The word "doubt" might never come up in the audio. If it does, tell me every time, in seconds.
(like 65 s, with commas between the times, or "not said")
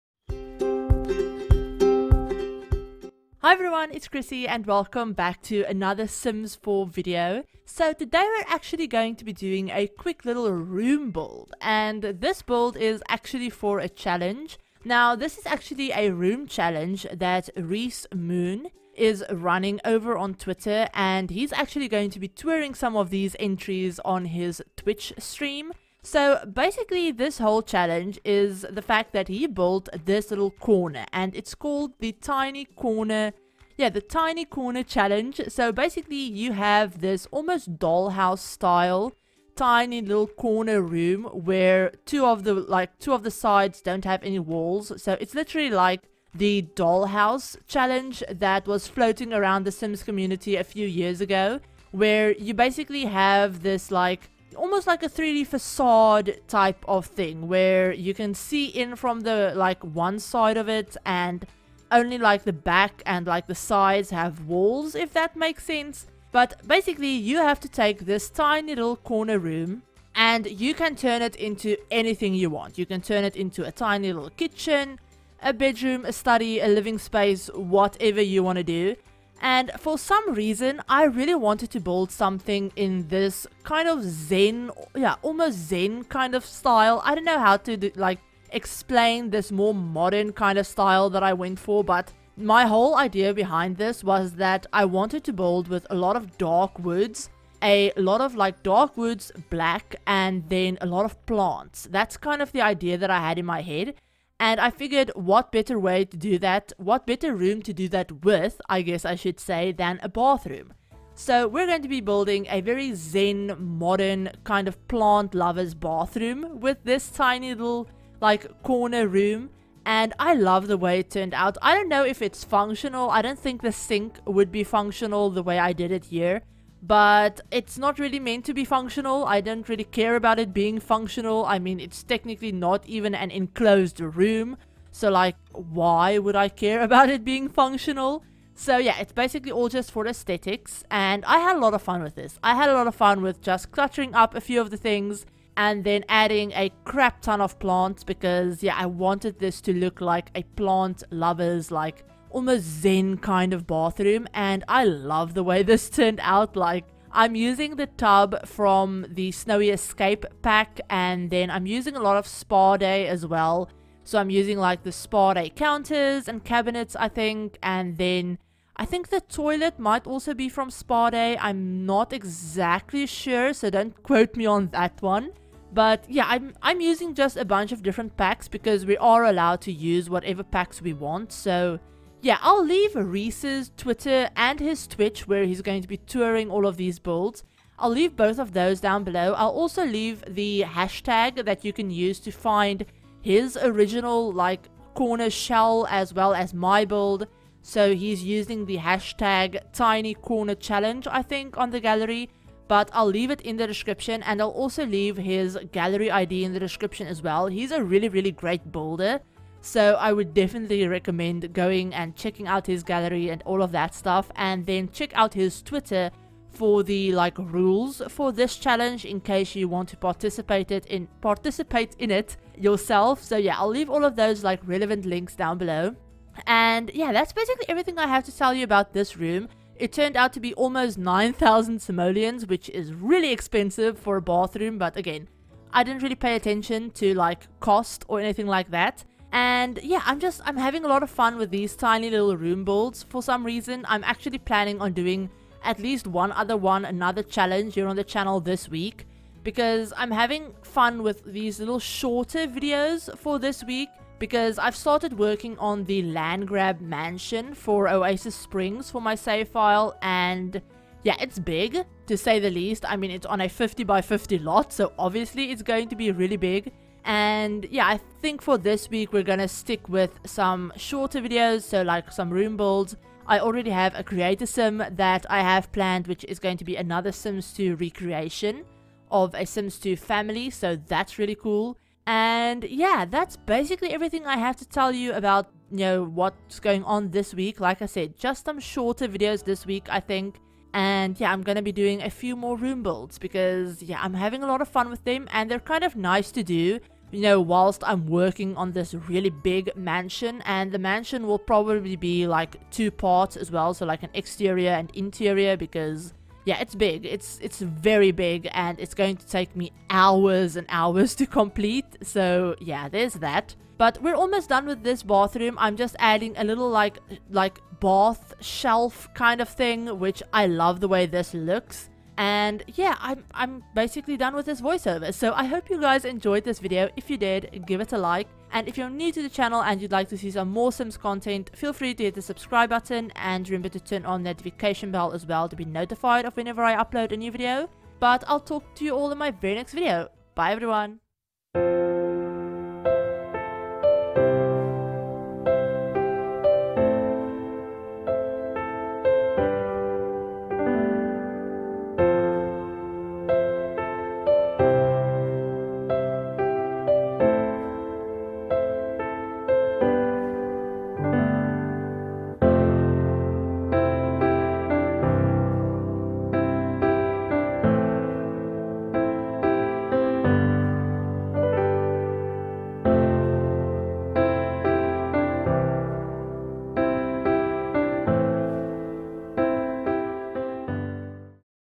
not said.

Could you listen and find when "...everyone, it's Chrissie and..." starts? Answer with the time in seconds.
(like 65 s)
3 s.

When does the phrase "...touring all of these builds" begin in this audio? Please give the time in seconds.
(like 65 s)
185 s.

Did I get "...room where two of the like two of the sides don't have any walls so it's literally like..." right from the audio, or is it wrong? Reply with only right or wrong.
right.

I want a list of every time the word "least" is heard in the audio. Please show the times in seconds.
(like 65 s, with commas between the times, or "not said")
245 s, 262 s.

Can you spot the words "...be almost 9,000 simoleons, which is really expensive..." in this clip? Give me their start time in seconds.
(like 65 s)
230 s.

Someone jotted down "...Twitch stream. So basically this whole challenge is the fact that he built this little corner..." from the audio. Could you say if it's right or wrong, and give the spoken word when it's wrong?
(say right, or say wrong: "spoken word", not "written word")
right.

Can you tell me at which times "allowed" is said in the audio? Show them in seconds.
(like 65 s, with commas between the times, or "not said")
179 s.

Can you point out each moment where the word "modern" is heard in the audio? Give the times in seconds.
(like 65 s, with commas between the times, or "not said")
89 s, 113 s.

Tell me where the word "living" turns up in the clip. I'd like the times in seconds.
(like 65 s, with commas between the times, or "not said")
76 s.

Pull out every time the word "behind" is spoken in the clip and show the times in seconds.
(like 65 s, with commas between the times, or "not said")
93 s.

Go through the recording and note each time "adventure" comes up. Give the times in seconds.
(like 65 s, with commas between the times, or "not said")
not said.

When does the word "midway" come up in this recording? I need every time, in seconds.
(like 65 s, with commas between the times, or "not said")
not said.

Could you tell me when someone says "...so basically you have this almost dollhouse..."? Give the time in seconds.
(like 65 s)
35 s.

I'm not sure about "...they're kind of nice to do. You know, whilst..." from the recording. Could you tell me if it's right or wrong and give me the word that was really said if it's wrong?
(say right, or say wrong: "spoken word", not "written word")
right.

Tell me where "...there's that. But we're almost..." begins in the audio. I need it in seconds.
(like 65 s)
312 s.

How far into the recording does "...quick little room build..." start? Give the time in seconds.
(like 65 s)
9 s.